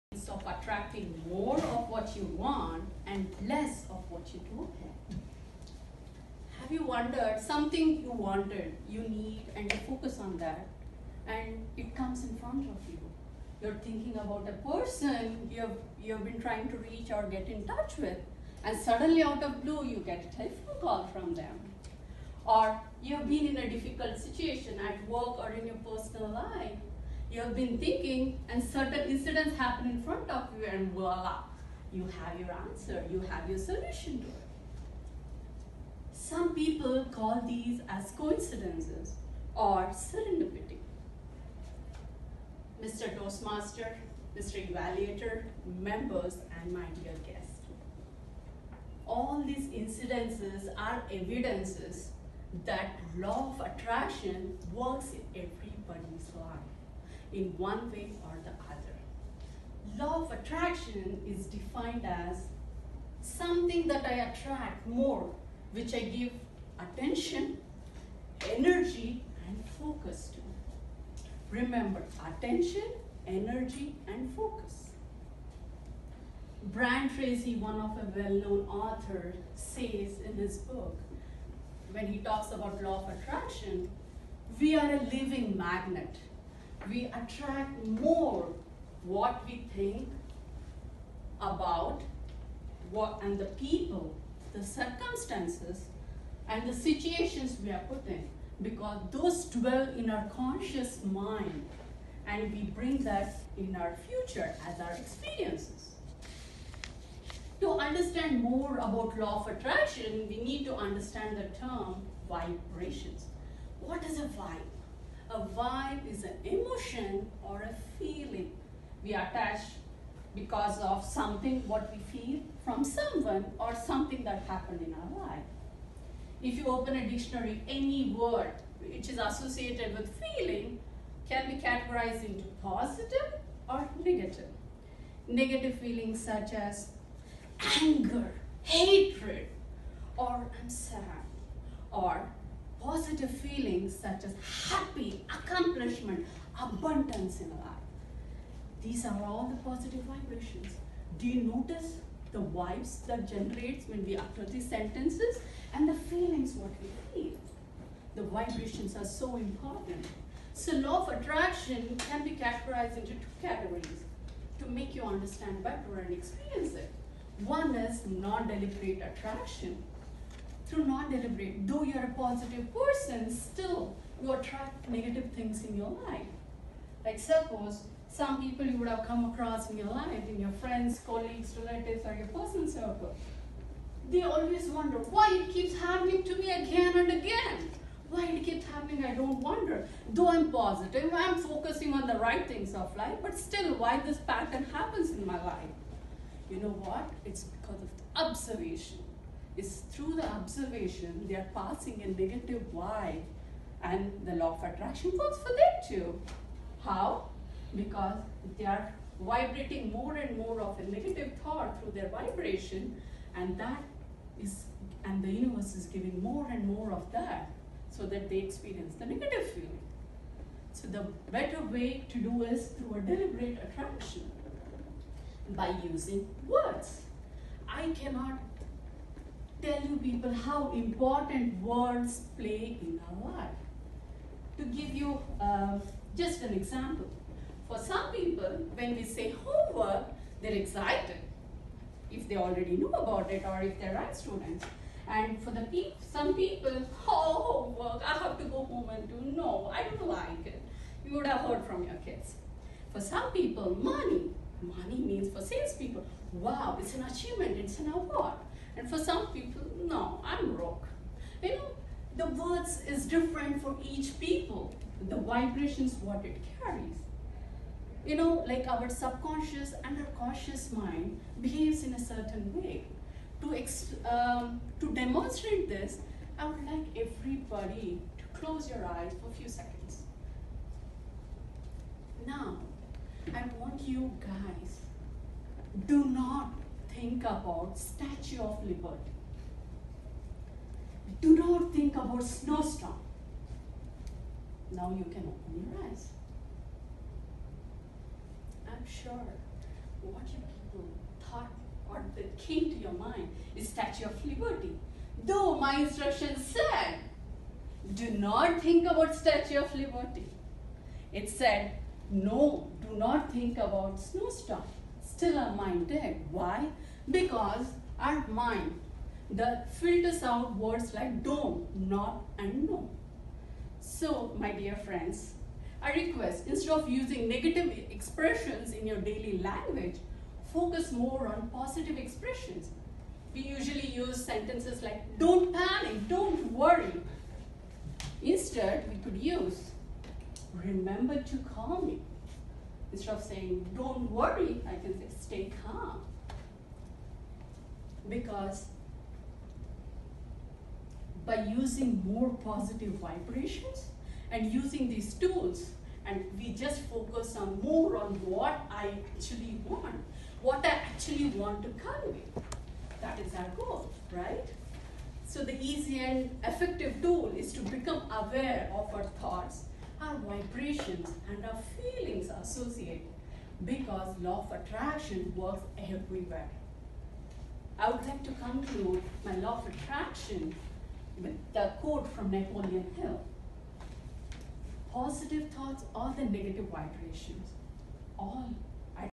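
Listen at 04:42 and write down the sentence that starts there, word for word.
Now, I want you guys, do not think about Statue of Liberty.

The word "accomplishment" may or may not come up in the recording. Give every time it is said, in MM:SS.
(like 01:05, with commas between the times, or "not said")
02:25.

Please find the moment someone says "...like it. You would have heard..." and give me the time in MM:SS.
04:10.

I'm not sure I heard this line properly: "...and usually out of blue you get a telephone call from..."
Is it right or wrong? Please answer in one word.
wrong.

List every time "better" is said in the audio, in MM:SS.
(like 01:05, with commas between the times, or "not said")
02:45, 03:41.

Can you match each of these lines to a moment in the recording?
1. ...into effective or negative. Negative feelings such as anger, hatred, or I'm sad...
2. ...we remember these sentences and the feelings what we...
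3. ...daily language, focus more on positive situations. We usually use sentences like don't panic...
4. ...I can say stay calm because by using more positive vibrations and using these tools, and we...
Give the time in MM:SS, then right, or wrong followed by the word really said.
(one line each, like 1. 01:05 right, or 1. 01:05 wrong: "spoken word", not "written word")
1. 02:12 wrong: "positive", not "effective"
2. 02:34 wrong: "utter", not "remember"
3. 05:28 wrong: "expressions", not "situations"
4. 05:44 right.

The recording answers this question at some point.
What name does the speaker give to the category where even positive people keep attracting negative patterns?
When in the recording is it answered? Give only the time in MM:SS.
02:48.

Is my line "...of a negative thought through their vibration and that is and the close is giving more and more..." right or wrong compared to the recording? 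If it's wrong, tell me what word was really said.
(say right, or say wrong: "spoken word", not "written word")
wrong: "universe", not "close".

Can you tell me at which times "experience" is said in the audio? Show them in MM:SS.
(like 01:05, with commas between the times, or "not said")
01:44, 02:46, 03:38.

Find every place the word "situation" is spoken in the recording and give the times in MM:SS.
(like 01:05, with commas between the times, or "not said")
00:24, 01:36.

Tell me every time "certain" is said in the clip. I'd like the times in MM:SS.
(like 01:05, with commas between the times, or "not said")
00:28, 04:31.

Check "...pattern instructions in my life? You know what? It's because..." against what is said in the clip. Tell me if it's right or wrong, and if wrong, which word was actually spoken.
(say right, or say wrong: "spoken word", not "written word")
wrong: "happens", not "instructions".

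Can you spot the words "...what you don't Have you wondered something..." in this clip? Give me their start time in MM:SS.
00:04.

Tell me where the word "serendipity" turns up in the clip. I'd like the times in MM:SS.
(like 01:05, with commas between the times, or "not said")
00:39.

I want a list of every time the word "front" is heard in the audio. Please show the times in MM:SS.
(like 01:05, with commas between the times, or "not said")
00:12, 00:30.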